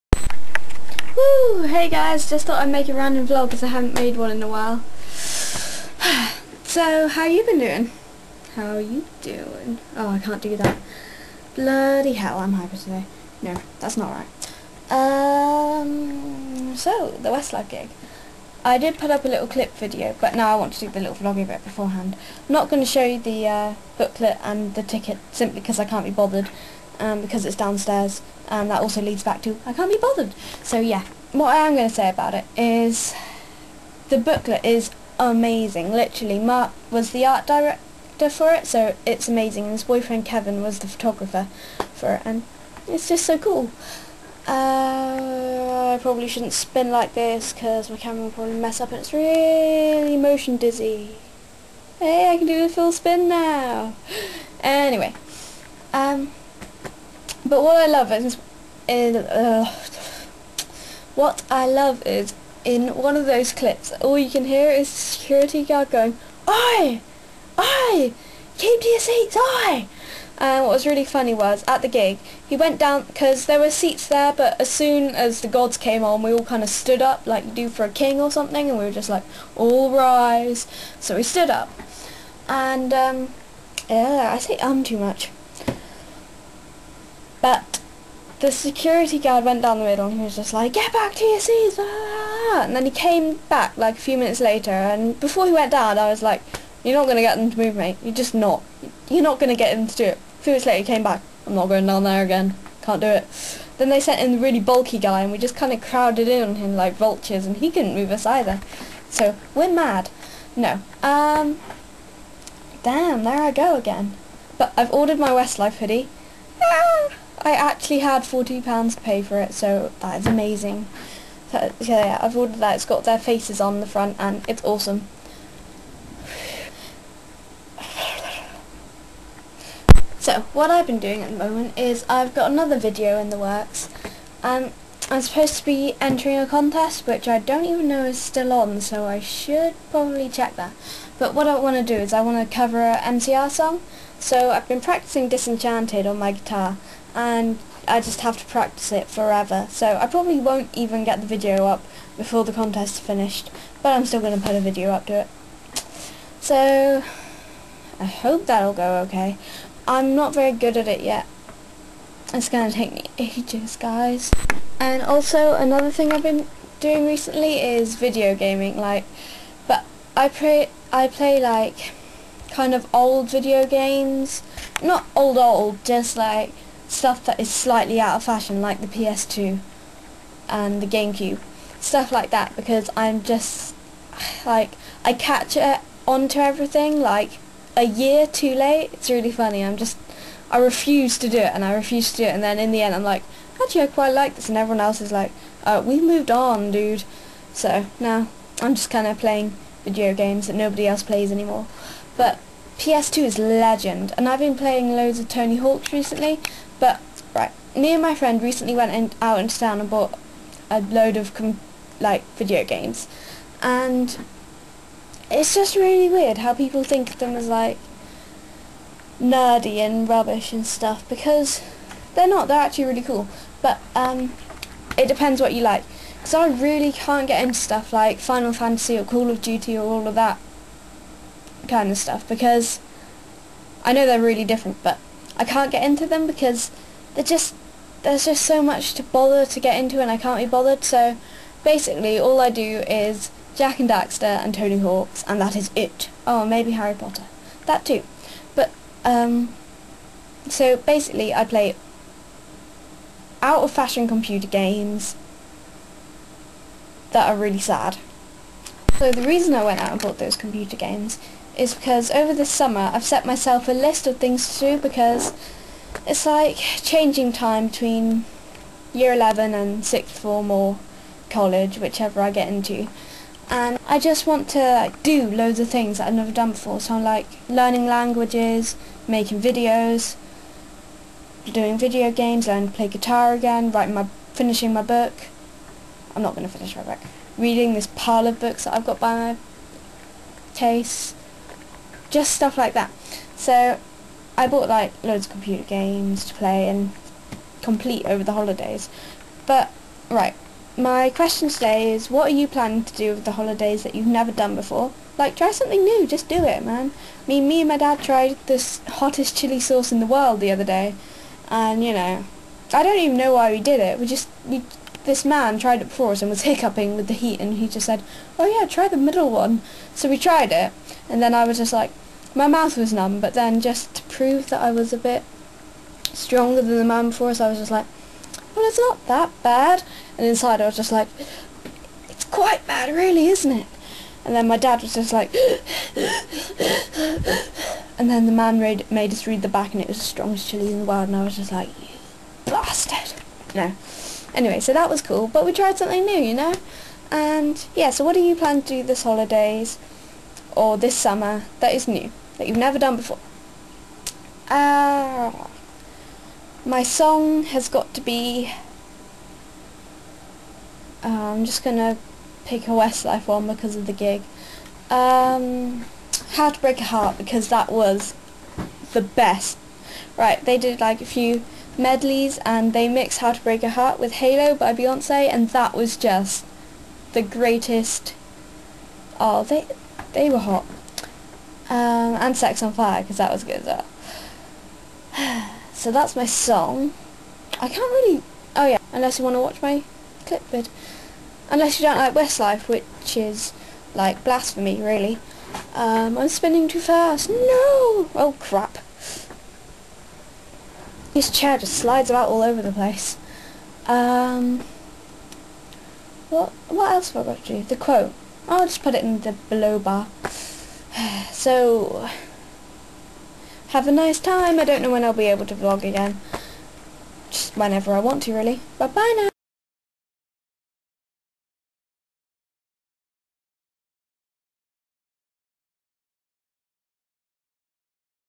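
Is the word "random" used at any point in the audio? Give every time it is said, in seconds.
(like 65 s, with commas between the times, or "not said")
2 s.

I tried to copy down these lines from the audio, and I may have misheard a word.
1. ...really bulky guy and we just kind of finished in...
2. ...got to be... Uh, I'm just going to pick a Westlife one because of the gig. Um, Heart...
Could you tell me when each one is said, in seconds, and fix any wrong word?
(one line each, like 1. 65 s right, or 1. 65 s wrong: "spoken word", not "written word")
1. 104 s wrong: "crowded", not "finished"
2. 357 s wrong: "How", not "Heart".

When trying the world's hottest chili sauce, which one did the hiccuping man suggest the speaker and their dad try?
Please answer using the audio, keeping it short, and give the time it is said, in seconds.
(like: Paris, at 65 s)
The middle one, at 318 s.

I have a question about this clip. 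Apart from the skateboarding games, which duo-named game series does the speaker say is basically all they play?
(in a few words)
Jak and Daxter.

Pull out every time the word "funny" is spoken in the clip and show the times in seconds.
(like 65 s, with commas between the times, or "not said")
71 s, 189 s.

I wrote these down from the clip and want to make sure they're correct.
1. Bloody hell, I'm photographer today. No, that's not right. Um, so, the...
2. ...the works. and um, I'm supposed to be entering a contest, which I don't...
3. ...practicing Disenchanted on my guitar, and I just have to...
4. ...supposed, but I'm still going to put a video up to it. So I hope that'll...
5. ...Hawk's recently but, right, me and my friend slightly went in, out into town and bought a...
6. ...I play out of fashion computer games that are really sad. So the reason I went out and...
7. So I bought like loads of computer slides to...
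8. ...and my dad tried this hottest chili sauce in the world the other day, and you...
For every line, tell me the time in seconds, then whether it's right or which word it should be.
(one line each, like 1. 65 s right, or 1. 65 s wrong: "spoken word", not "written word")
1. 11 s wrong: "hyper", not "photographer"
2. 133 s right
3. 144 s right
4. 152 s wrong: "finished", not "supposed"
5. 205 s wrong: "recently", not "slightly"
6. 251 s right
7. 293 s wrong: "games", not "slides"
8. 307 s right.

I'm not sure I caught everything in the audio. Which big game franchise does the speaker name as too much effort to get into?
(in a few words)
Final Fantasy.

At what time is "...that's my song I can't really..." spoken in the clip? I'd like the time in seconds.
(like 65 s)
385 s.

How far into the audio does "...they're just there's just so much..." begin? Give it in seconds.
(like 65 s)
237 s.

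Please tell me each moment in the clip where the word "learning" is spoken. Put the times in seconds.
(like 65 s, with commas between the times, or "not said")
277 s, 282 s.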